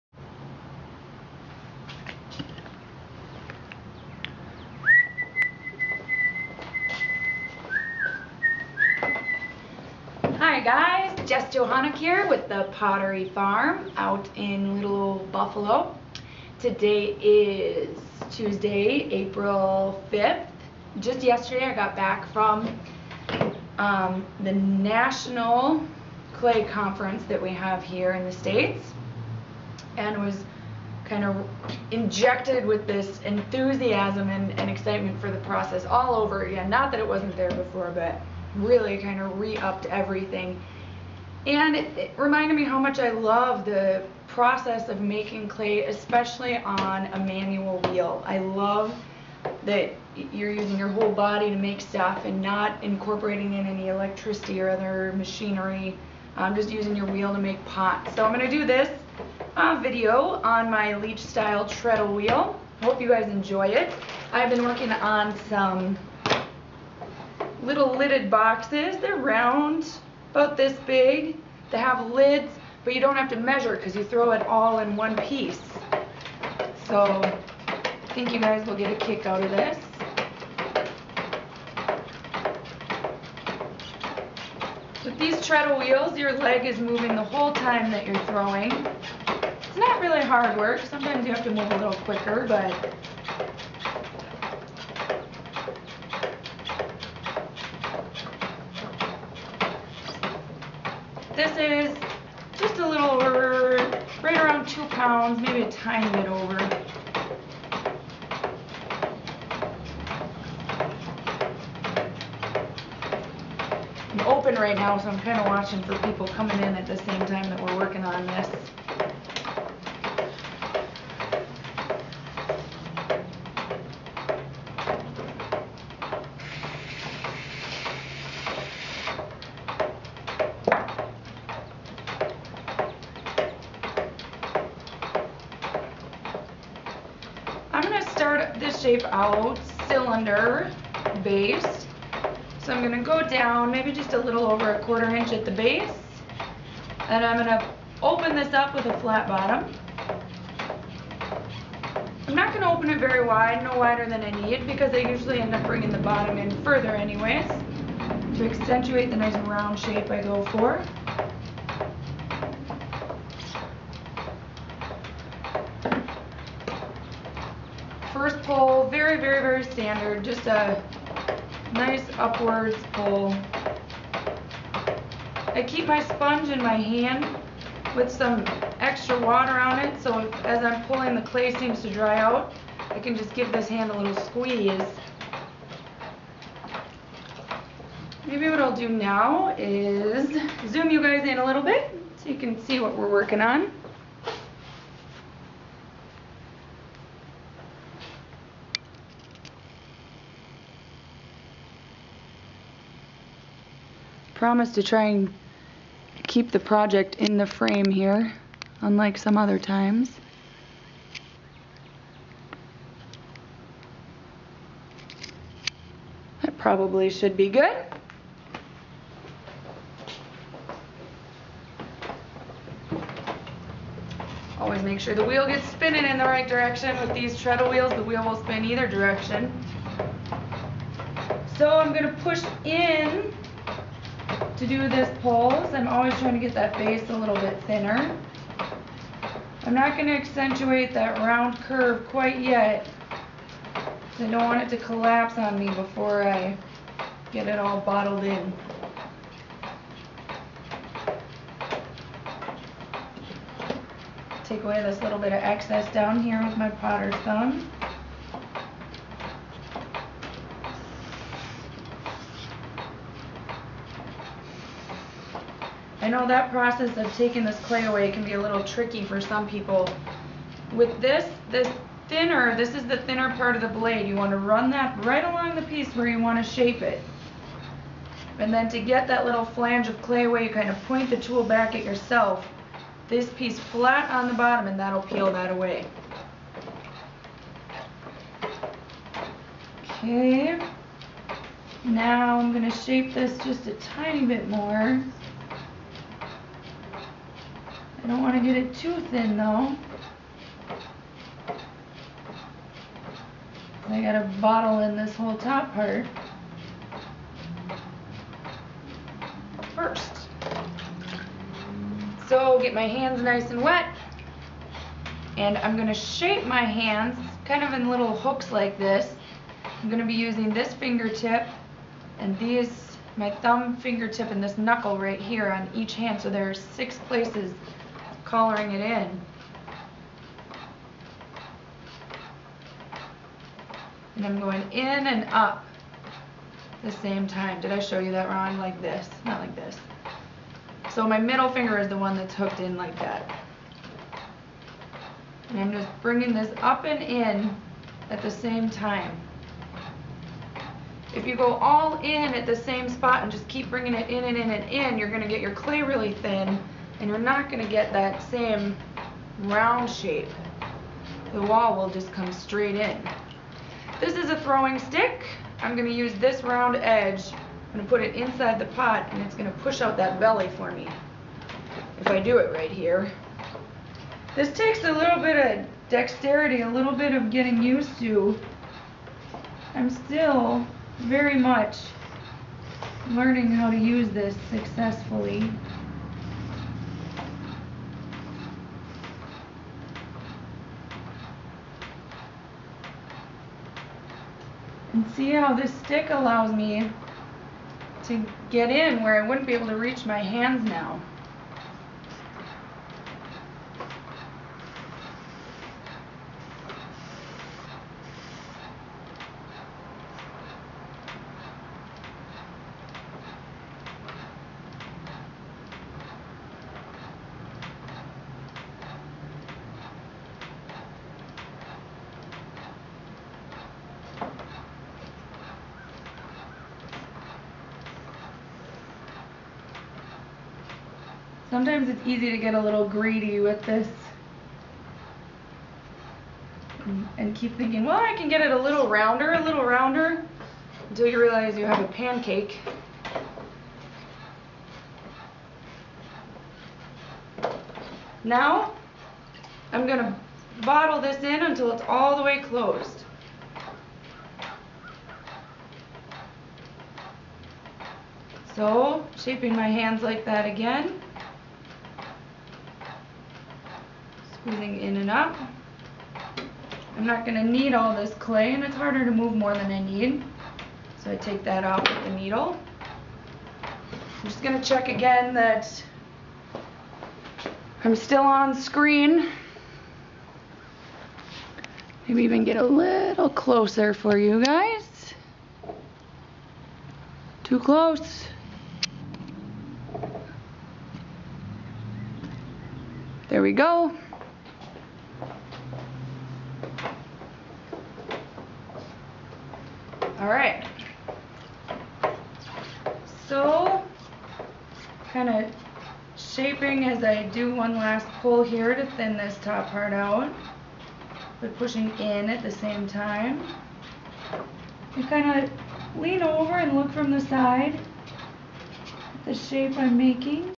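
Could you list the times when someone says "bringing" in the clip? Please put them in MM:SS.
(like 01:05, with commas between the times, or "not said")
02:35, 05:46, 05:53.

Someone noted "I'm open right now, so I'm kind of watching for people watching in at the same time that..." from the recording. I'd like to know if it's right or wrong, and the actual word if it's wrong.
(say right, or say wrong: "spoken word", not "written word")
wrong: "coming", not "watching".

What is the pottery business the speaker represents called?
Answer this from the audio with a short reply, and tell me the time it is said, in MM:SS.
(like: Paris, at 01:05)
The Pottery Farm, at 00:12.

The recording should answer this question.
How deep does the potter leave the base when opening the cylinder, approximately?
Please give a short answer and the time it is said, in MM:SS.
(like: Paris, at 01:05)
a little over a quarter inch, at 02:24.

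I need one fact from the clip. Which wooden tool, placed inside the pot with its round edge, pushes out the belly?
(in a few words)
throwing stick.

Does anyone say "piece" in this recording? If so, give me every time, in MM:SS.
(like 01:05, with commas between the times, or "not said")
01:15, 04:35, 04:43.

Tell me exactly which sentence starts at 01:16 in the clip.
So I think you guys will get a kick out of this.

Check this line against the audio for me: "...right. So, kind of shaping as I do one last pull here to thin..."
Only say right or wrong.
right.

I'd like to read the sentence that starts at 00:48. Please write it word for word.
I love that you're using your whole body to make stuff and not incorporating in any electricity or other machinery.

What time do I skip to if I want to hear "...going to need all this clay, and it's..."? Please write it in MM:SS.
07:47.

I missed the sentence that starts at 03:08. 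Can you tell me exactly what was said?
Maybe what I'll do now is zoom you guys in a little bit so you can see what we're working on.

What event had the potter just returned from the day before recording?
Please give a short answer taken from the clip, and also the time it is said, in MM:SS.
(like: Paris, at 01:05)
National Clay Conference, at 00:24.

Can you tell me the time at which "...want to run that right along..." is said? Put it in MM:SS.
04:34.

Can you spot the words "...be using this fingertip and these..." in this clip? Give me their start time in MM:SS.
05:20.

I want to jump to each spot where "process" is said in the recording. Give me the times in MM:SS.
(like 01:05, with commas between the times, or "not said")
00:35, 00:44, 04:26.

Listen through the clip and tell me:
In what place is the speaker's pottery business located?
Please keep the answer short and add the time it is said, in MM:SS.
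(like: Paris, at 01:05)
Little Buffalo, at 00:14.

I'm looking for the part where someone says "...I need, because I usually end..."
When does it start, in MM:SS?
02:34.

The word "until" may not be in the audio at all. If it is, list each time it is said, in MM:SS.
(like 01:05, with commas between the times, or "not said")
07:20, 07:31.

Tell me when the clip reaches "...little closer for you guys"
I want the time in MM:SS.
08:02.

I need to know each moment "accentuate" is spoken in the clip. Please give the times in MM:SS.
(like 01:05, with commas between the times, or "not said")
02:38, 04:00.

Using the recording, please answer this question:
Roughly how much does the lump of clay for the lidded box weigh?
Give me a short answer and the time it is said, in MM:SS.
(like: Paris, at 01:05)
2 pounds, at 01:44.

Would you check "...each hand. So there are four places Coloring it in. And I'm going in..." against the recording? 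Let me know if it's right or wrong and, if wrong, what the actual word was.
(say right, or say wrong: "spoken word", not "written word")
wrong: "six", not "four".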